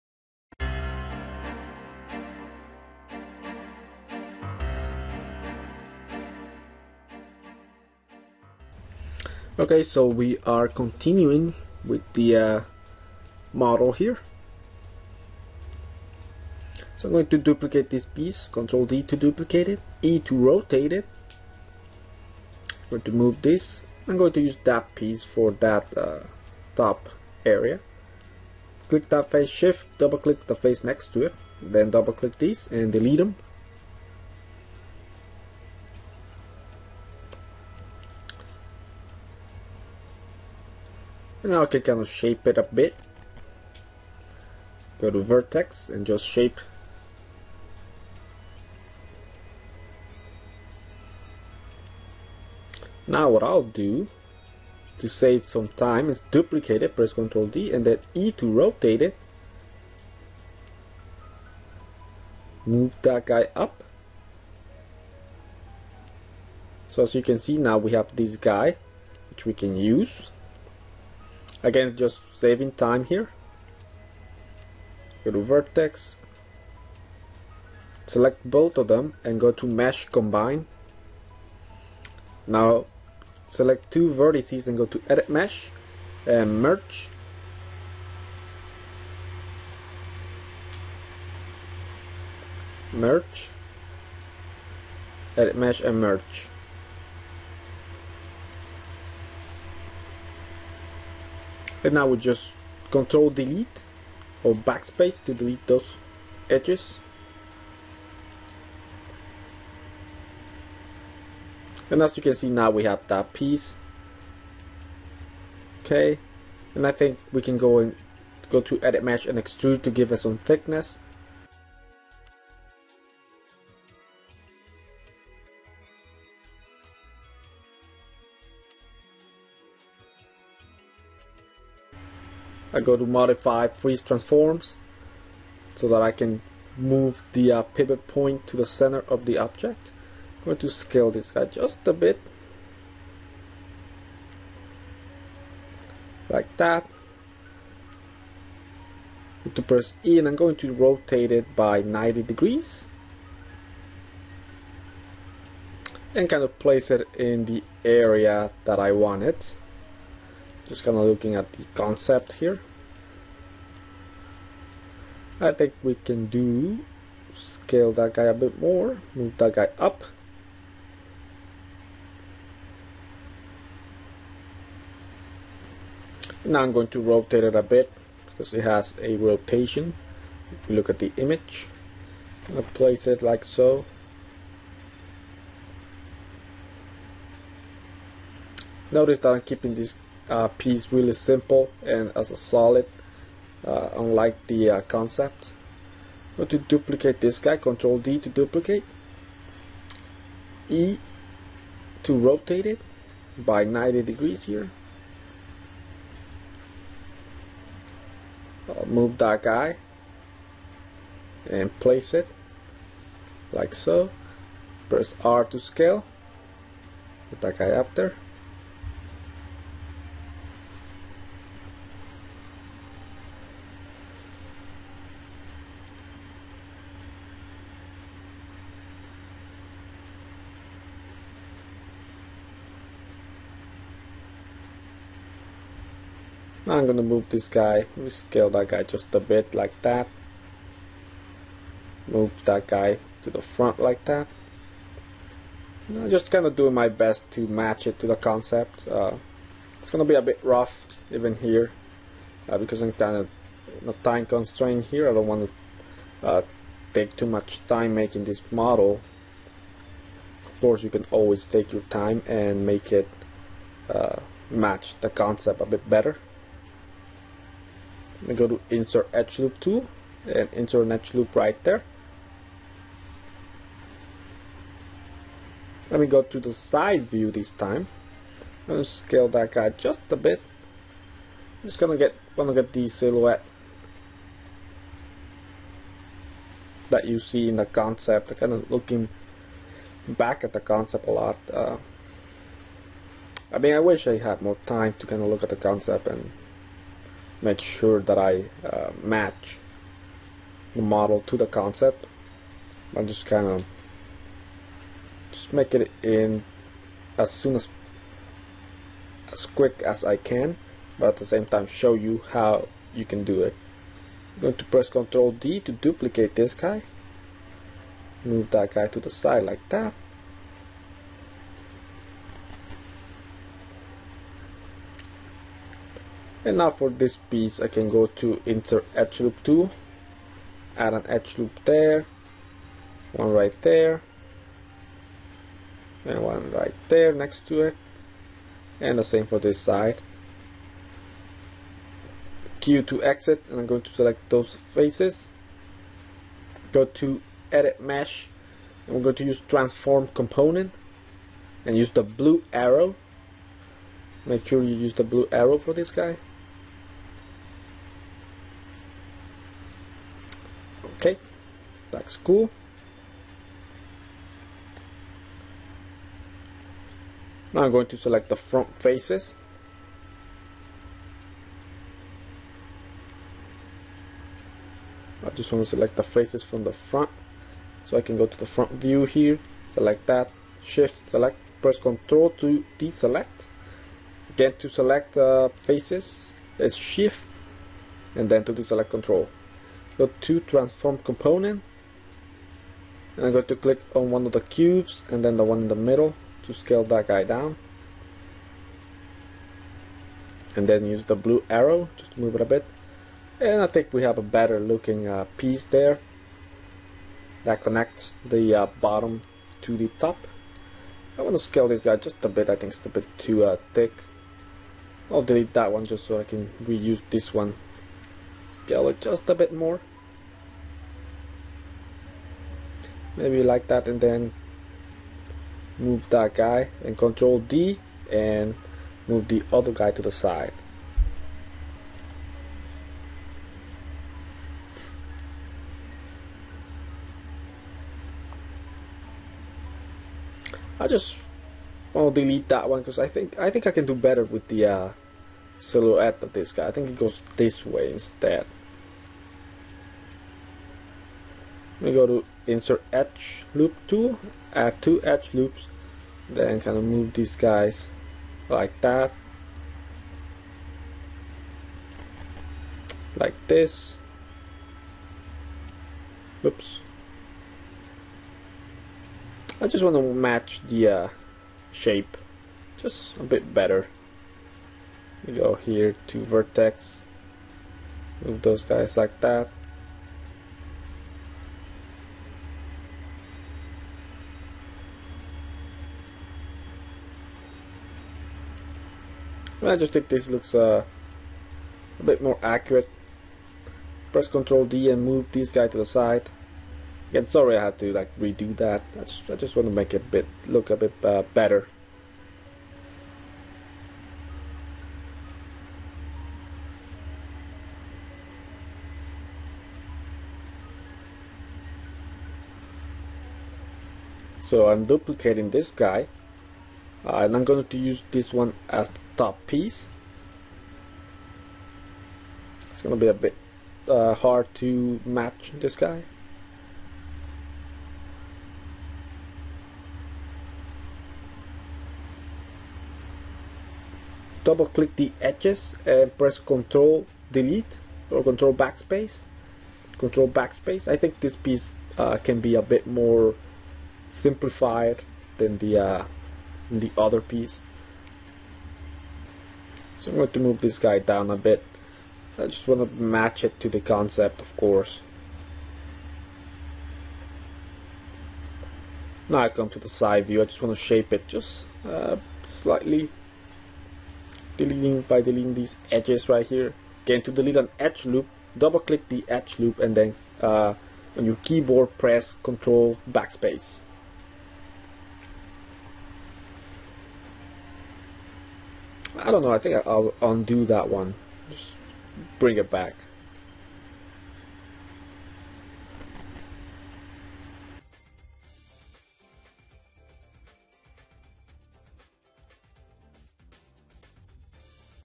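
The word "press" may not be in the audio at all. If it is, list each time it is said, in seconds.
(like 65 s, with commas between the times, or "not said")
56 s, 149 s, 214 s, 314 s, 381 s, 494 s, 536 s, 571 s.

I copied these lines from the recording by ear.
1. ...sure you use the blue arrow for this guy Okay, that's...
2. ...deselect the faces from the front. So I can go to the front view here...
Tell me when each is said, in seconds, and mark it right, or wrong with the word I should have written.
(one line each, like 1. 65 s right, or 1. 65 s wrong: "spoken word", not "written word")
1. 354 s right
2. 375 s wrong: "select", not "deselect".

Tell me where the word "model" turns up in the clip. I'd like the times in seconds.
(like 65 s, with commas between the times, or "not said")
13 s, 258 s, 300 s.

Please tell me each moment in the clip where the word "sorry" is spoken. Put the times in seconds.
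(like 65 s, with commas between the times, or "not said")
497 s.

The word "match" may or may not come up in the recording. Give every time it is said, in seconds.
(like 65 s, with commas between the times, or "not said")
247 s, 264 s, 299 s, 470 s, 525 s, 553 s.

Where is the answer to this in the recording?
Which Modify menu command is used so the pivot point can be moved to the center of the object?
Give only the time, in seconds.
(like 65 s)
133 s.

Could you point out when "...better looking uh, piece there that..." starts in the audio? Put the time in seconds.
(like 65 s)
404 s.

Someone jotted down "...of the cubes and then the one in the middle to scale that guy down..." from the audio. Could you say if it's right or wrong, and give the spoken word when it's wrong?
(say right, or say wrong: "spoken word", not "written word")
right.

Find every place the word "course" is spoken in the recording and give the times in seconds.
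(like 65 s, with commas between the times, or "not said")
260 s, 554 s.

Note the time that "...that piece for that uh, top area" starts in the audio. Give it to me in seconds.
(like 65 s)
24 s.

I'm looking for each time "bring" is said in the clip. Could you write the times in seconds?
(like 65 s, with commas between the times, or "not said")
582 s.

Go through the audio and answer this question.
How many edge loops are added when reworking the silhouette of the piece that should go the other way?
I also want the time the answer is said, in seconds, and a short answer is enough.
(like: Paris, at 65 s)
2, at 454 s.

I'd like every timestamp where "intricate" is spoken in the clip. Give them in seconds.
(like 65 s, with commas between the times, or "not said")
not said.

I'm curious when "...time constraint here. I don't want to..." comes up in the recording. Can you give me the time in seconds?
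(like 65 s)
253 s.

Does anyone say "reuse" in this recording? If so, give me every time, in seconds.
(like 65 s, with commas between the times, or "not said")
416 s.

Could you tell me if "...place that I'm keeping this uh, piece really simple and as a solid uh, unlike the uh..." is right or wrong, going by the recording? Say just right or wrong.
wrong.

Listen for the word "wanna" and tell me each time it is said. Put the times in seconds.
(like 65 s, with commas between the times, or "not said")
282 s.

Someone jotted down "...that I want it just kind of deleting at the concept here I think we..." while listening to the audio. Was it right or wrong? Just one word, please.
wrong.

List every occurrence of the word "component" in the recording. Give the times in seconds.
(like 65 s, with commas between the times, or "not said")
350 s, 391 s.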